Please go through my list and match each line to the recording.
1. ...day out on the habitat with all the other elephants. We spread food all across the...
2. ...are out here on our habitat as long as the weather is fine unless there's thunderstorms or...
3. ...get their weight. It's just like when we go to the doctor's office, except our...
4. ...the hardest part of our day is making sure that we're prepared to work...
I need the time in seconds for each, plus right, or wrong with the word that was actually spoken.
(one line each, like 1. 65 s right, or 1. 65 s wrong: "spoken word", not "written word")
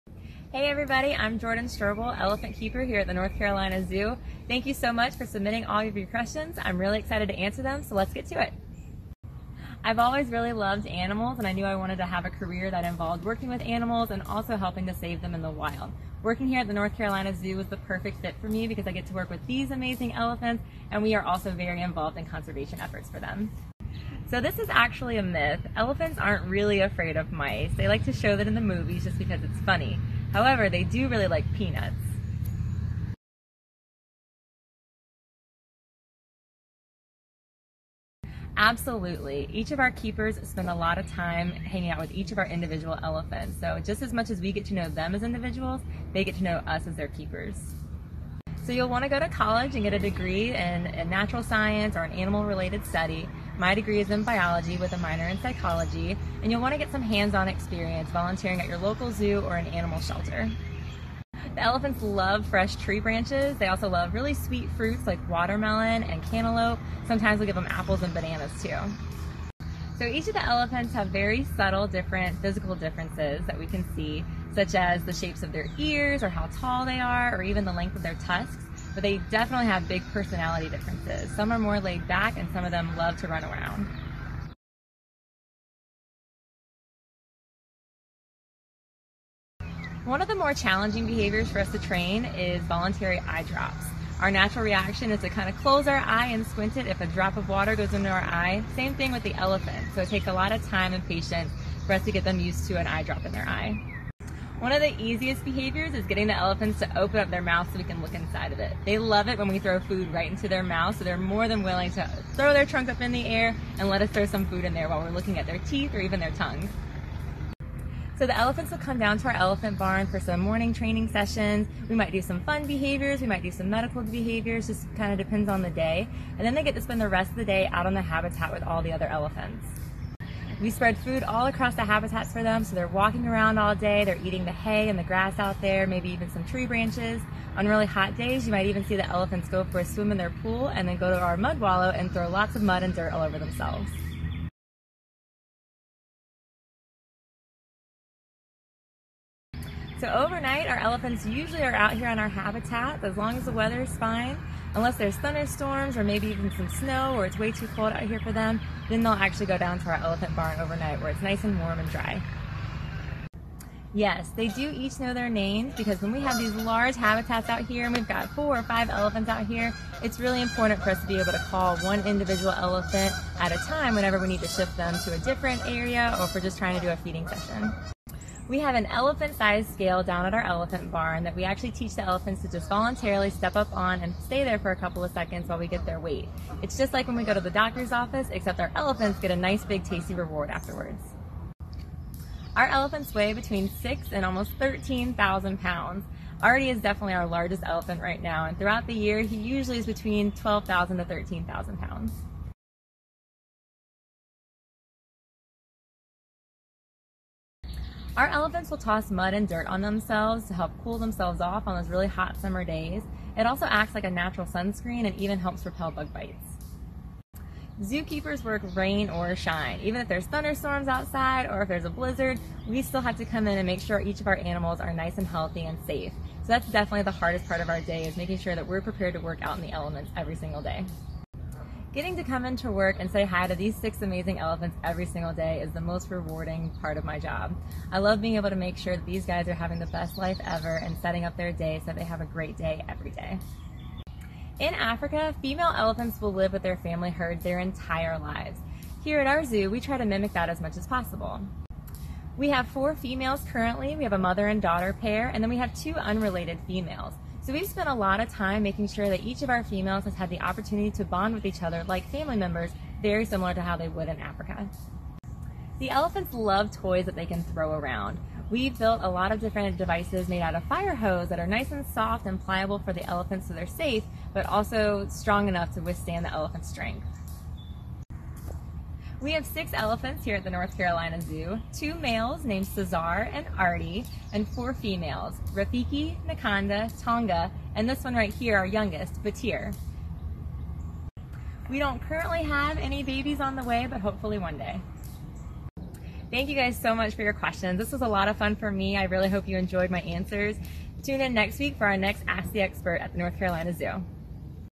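1. 127 s right
2. 151 s right
3. 185 s right
4. 227 s right.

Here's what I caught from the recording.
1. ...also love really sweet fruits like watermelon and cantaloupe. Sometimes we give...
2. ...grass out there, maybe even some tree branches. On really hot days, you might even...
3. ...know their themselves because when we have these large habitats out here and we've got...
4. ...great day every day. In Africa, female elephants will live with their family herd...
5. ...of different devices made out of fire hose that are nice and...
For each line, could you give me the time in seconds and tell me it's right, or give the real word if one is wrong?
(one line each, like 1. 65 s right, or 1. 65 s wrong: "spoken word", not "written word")
1. 63 s right
2. 135 s right
3. 165 s wrong: "names", not "themselves"
4. 242 s right
5. 269 s right.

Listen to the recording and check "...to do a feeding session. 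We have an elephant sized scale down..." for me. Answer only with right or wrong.
right.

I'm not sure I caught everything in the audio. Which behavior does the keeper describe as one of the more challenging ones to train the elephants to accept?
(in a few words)
Voluntary eye drops.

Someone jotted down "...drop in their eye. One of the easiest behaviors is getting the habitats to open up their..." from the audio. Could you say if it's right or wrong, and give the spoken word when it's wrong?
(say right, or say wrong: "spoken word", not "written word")
wrong: "elephants", not "habitats".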